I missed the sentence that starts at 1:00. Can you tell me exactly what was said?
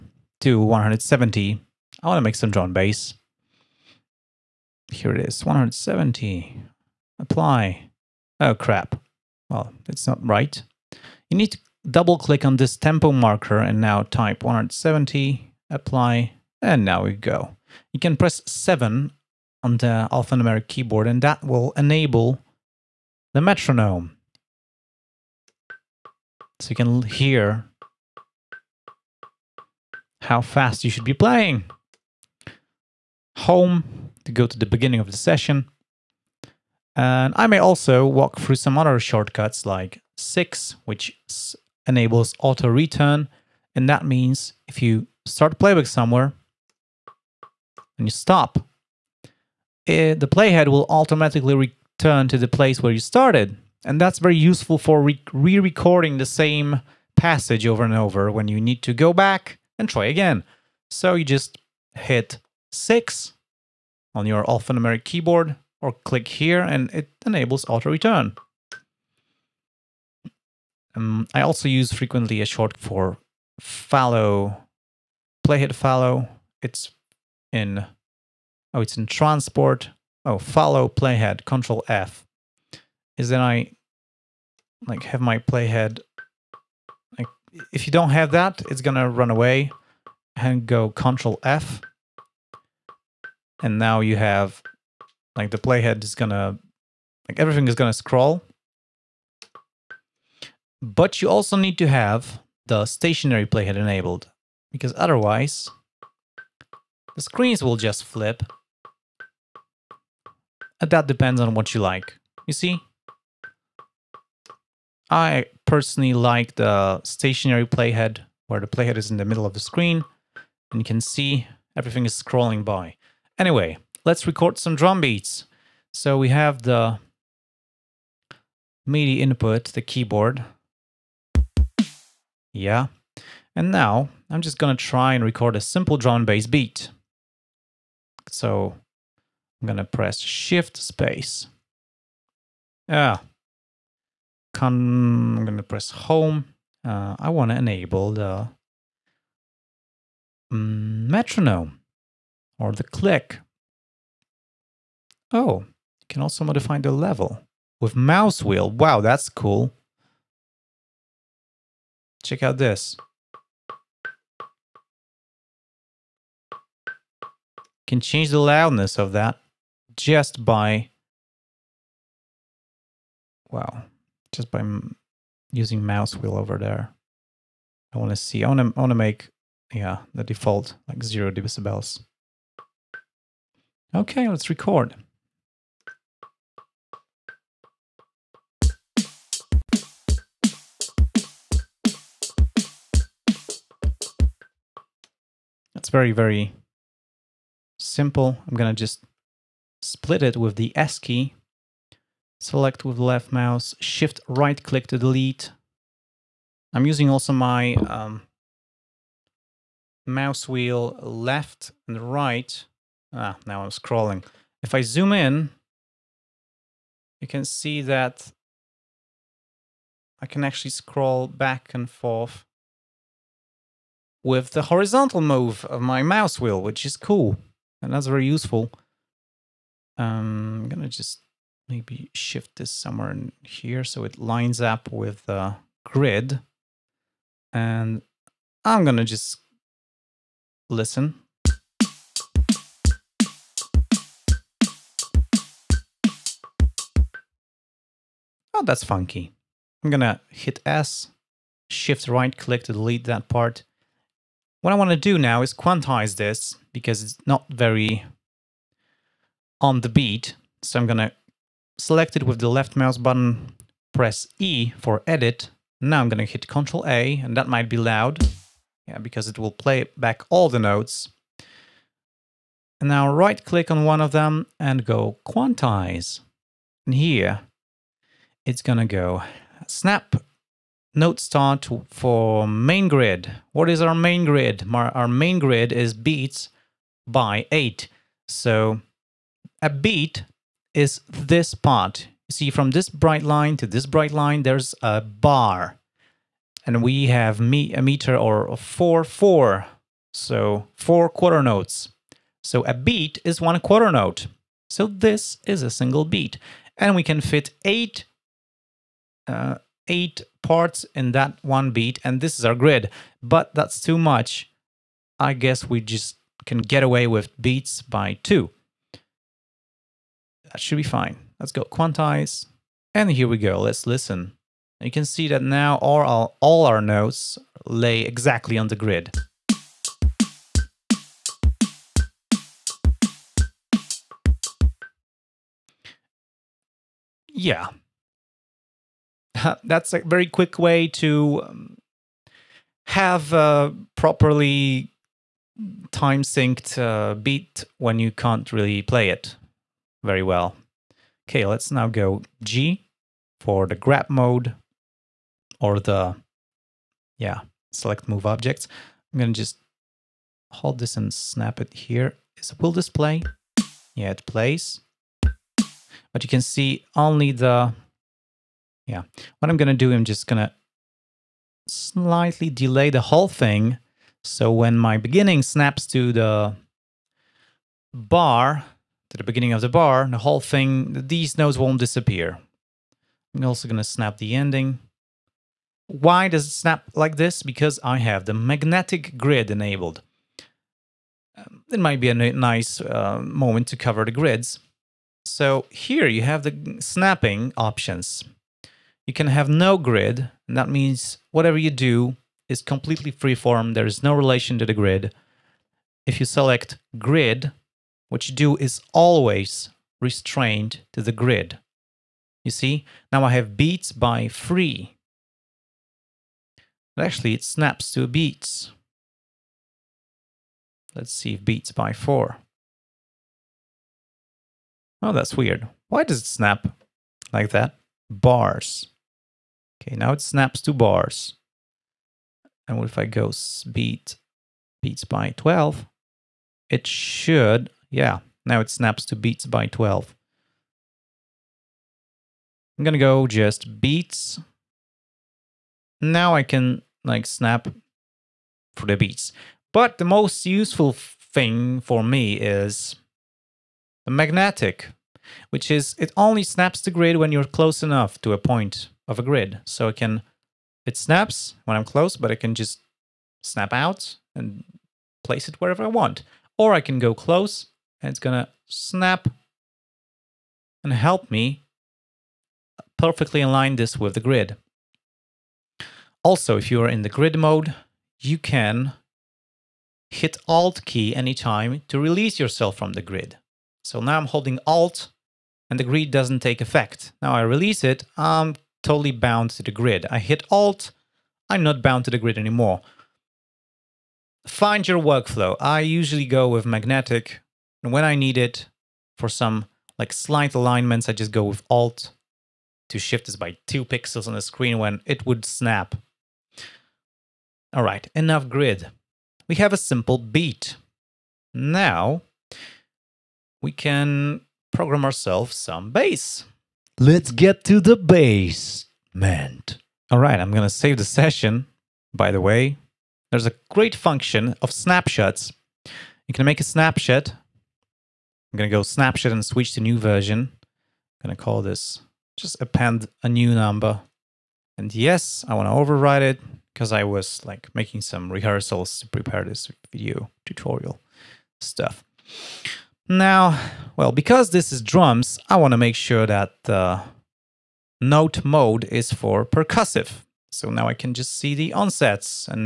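So you just hit 6 on your alphanumeric keyboard or click here and it enables auto-return.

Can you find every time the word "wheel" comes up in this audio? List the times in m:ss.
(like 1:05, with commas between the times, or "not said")
2:38, 2:56, 3:30, 3:46.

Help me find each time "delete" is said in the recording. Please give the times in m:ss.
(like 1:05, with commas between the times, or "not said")
3:24, 4:12.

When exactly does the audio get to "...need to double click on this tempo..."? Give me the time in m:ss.
0:11.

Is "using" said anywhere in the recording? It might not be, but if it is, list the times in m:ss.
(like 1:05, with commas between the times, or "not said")
2:55, 3:26.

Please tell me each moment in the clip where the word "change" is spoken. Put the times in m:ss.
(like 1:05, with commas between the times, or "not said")
2:47.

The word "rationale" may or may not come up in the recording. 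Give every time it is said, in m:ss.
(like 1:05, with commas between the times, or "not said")
not said.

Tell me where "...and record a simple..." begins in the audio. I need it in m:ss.
2:15.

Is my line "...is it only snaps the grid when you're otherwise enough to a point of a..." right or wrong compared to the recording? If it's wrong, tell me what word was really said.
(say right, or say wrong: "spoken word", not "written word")
wrong: "close", not "otherwise".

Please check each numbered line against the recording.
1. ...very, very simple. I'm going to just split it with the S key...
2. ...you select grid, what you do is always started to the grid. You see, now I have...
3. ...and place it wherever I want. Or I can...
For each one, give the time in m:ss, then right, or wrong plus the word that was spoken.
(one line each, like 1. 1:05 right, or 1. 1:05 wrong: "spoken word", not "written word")
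1. 3:15 right
2. 6:46 wrong: "restrained", not "started"
3. 7:44 right.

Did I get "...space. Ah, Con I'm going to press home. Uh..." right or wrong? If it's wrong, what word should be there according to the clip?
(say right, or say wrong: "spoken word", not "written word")
right.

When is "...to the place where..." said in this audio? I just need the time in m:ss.
0:52.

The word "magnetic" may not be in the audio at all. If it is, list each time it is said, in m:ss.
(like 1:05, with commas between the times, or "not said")
6:28, 7:34, 8:16.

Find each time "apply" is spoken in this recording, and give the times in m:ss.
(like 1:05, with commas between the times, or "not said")
0:07, 0:15.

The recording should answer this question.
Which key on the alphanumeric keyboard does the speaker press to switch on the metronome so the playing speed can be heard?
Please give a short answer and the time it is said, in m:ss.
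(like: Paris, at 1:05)
7, at 0:18.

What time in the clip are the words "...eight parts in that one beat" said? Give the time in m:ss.
5:09.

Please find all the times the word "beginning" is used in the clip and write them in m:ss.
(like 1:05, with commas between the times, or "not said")
0:34, 6:14, 6:19.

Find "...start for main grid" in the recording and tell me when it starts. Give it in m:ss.
4:41.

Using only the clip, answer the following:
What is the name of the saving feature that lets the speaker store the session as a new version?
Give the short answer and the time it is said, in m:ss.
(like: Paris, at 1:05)
Snapshots, at 8:44.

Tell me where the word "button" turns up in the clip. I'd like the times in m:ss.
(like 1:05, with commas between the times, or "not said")
4:22.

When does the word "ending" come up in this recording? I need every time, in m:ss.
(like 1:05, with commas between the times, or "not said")
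6:24.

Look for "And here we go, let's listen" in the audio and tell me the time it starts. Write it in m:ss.
5:22.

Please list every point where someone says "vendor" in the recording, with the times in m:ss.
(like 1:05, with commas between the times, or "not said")
not said.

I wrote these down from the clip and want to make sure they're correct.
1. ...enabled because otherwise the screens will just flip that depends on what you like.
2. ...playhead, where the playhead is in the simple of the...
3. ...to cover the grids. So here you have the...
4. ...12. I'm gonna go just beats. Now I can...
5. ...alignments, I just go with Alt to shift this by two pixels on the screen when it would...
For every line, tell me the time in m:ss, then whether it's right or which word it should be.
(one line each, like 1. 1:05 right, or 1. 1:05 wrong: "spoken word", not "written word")
1. 1:43 right
2. 1:57 wrong: "middle", not "simple"
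3. 6:33 right
4. 7:19 right
5. 8:20 right.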